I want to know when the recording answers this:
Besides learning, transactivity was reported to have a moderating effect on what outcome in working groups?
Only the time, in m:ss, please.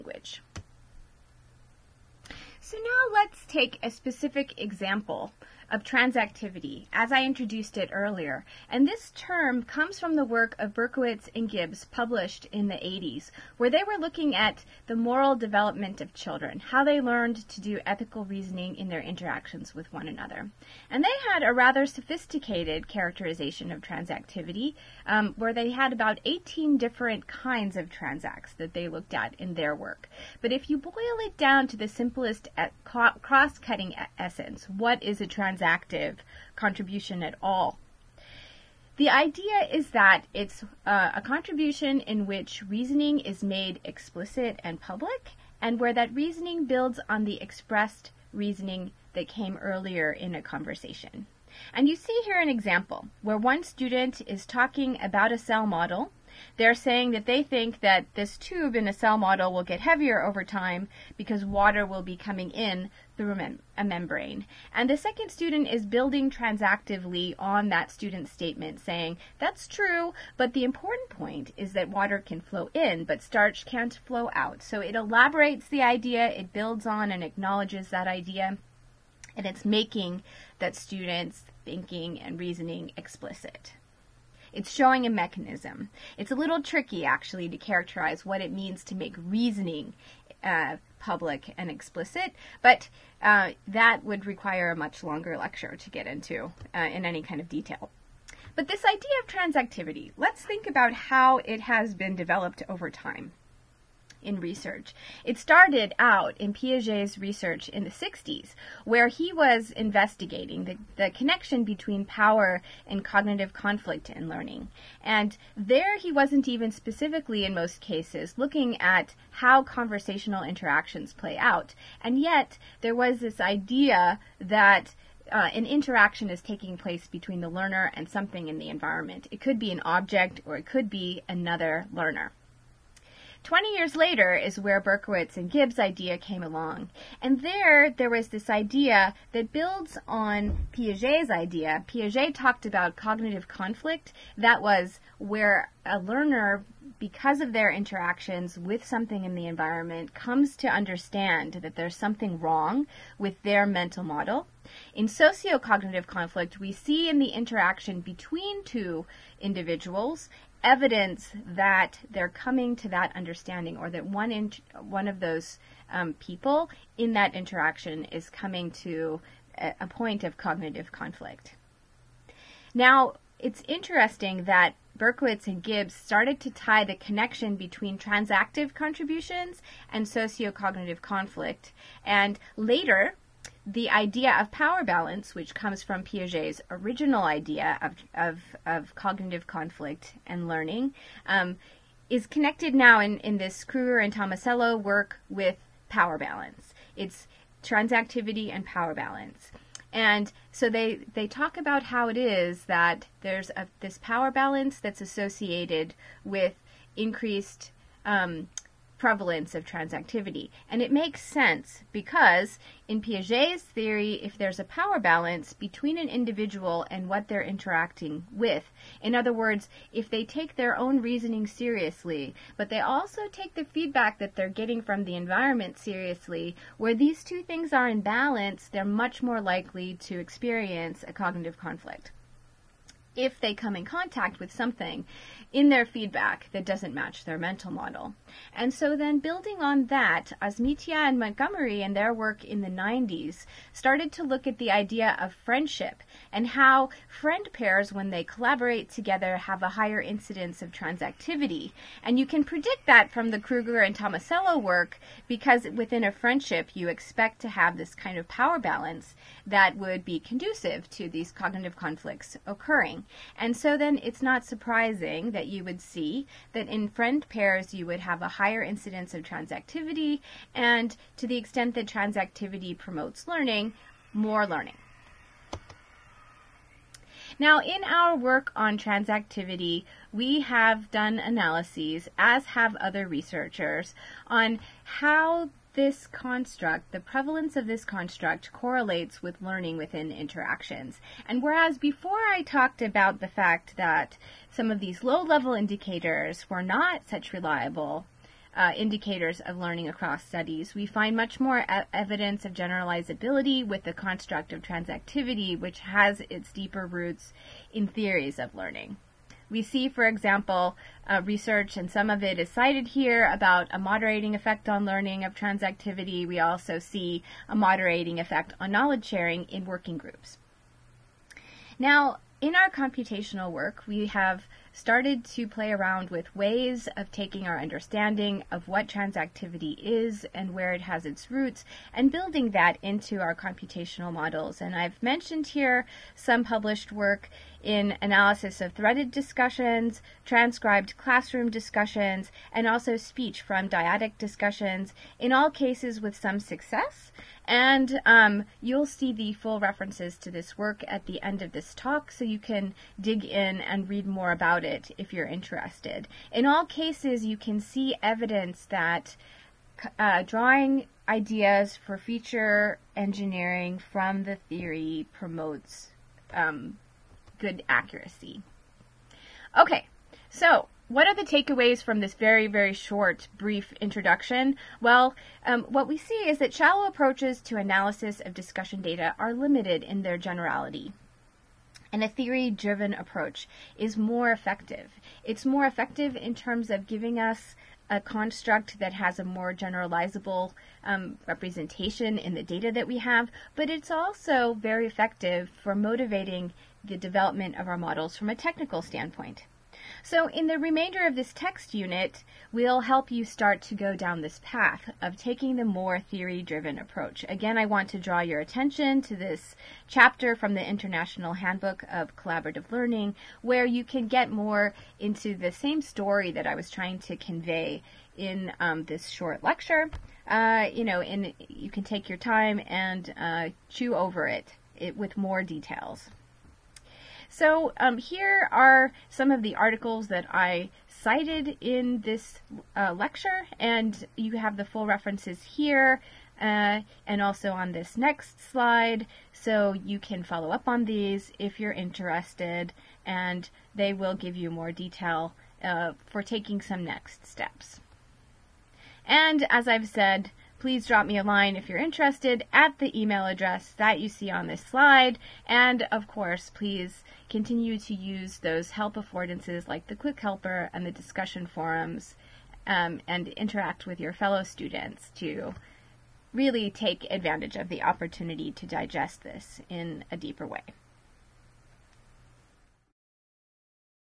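5:18.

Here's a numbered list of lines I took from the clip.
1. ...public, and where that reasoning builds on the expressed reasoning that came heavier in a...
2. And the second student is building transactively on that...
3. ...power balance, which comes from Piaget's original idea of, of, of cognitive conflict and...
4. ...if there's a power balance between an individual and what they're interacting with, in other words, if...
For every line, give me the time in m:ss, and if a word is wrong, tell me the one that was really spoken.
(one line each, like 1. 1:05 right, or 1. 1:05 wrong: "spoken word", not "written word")
1. 0:44 wrong: "earlier", not "heavier"
2. 1:04 right
3. 3:04 right
4. 3:34 right.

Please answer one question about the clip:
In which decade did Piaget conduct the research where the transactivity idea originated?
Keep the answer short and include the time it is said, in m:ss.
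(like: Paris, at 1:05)
the 60s, at 1:47.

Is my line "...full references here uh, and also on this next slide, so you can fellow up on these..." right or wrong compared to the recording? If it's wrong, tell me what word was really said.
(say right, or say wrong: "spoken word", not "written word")
wrong: "follow", not "fellow".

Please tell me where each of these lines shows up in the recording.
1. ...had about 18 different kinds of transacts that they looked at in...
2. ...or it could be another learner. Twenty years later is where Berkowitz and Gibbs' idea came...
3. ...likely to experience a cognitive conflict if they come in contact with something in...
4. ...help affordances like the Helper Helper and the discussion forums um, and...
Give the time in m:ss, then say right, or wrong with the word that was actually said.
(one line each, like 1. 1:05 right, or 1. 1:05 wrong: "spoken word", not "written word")
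1. 0:25 right
2. 2:10 right
3. 3:49 right
4. 7:38 wrong: "Quick", not "Helper".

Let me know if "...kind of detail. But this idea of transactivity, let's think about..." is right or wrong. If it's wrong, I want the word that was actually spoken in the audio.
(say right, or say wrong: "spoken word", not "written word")
right.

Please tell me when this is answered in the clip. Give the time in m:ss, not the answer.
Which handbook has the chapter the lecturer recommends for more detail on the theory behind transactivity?
6:50.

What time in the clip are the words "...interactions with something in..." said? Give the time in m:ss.
2:27.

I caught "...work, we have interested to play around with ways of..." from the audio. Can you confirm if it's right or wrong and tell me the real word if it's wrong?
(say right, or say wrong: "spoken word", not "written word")
wrong: "started", not "interested".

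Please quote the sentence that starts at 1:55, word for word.
And there he wasn't even specifically, in most cases, looking at how conversational interactions play out.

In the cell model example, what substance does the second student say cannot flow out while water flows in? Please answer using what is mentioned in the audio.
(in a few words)
starch.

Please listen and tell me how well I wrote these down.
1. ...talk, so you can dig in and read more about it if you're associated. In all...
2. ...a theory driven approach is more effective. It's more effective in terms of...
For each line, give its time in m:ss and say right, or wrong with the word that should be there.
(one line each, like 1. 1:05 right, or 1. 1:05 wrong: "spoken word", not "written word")
1. 5:51 wrong: "interested", not "associated"
2. 6:22 right.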